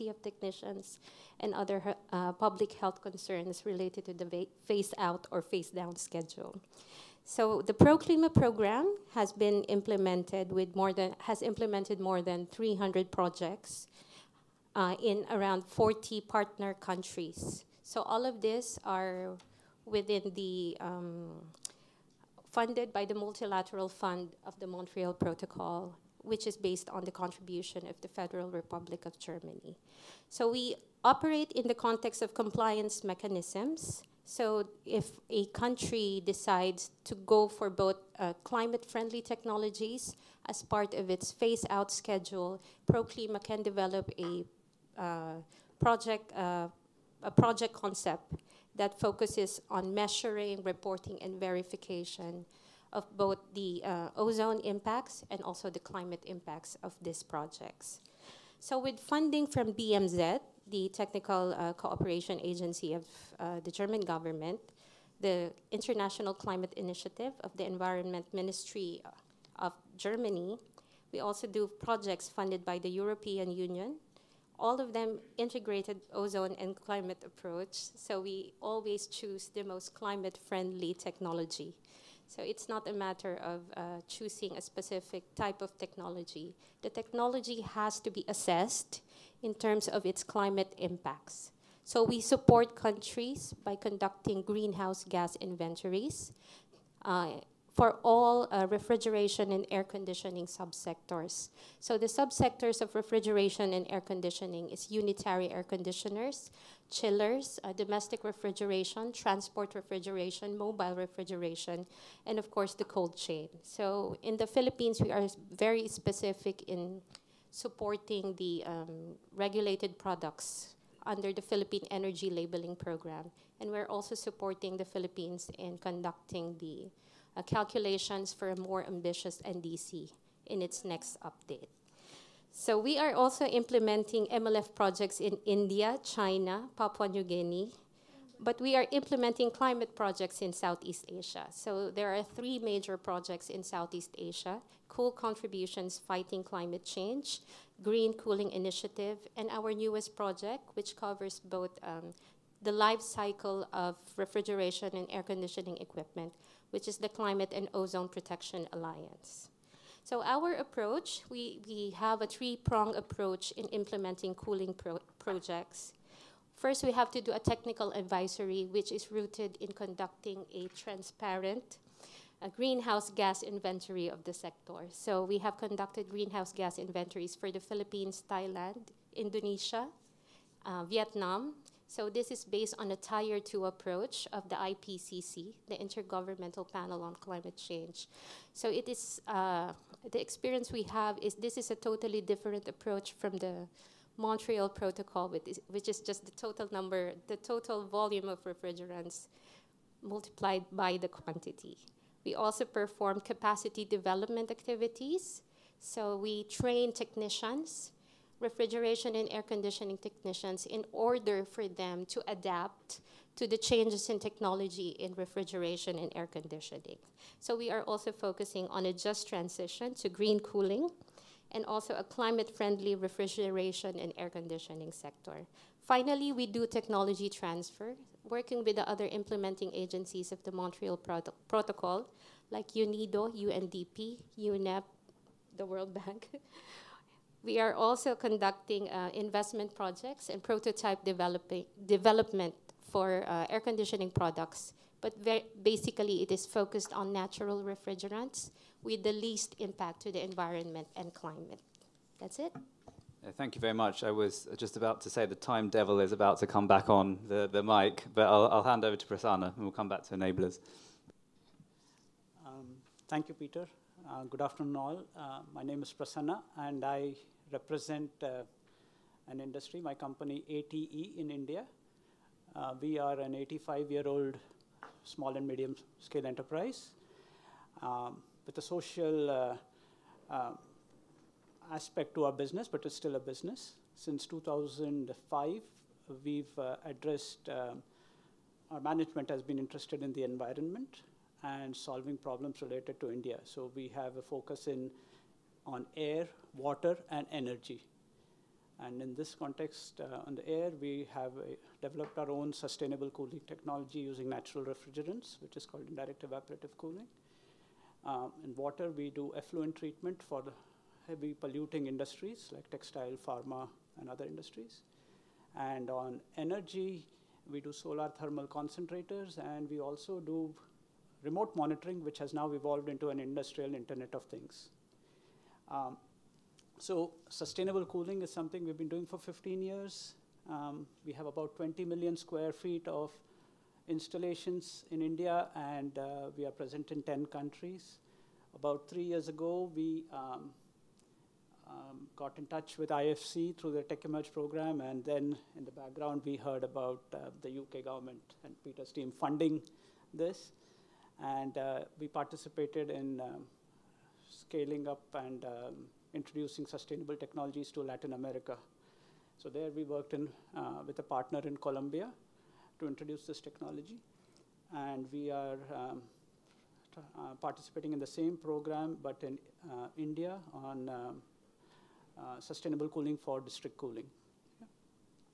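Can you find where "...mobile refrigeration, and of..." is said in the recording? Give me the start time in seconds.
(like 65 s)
110 s.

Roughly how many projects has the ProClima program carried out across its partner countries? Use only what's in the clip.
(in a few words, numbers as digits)
more than 300.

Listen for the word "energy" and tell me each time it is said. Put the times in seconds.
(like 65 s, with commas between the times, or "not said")
121 s, 297 s, 316 s.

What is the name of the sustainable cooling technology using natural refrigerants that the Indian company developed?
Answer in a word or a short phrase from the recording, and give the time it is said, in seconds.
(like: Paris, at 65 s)
indirect evaporative cooling, at 305 s.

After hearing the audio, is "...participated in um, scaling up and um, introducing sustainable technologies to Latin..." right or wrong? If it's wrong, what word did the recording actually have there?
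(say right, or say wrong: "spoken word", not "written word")
right.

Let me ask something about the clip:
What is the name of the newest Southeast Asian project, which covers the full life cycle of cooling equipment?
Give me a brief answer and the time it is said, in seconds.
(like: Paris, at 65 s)
Climate and Ozone Protection Alliance, at 157 s.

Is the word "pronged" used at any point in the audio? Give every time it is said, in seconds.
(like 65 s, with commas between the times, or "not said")
162 s.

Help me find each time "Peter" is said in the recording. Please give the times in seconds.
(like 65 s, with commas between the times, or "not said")
263 s, 348 s.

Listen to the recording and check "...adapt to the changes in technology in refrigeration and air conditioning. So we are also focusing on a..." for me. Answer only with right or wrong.
right.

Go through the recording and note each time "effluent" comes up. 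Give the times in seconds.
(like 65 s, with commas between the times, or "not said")
309 s.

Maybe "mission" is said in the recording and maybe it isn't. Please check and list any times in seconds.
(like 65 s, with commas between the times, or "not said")
not said.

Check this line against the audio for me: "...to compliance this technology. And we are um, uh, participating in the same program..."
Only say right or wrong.
wrong.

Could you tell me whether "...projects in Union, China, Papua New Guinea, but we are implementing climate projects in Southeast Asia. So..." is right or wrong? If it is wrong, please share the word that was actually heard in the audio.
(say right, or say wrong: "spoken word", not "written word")
wrong: "India", not "Union".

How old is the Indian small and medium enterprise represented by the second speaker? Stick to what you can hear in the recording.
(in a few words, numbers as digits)
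85 years.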